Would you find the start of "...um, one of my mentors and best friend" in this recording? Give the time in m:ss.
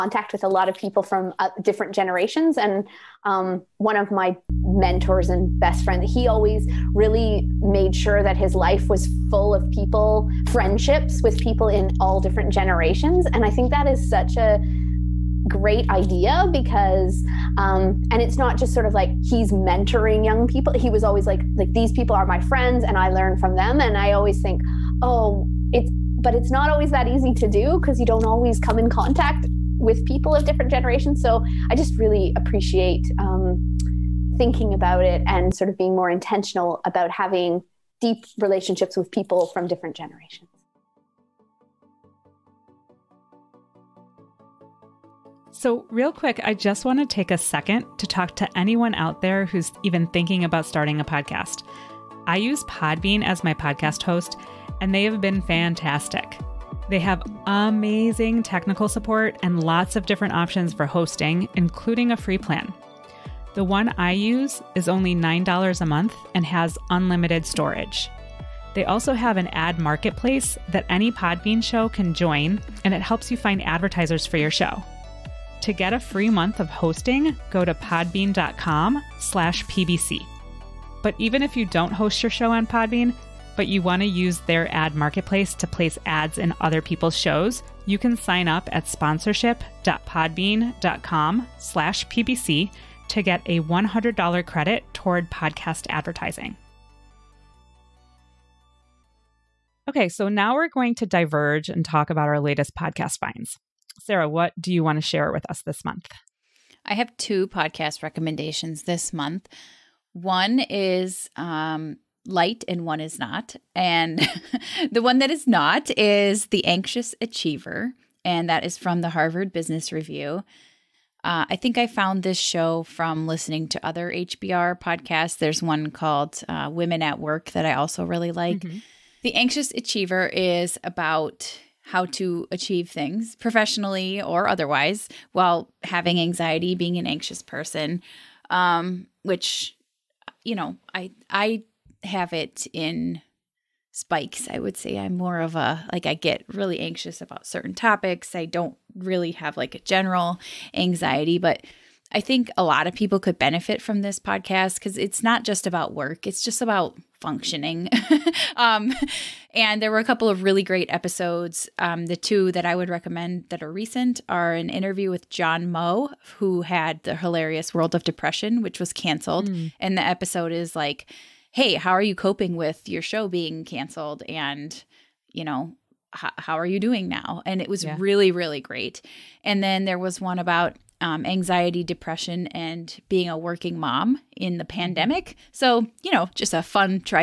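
0:03.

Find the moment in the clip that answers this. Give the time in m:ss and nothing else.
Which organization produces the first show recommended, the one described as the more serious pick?
1:59.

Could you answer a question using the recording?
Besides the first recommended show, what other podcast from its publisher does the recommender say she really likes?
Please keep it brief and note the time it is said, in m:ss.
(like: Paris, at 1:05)
Women at Work, at 2:06.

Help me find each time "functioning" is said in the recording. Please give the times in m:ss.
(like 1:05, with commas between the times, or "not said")
2:37.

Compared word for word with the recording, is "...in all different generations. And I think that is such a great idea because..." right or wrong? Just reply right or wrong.
right.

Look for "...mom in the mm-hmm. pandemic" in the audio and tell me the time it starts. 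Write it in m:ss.
3:03.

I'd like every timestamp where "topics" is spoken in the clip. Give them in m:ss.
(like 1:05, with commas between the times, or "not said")
2:27.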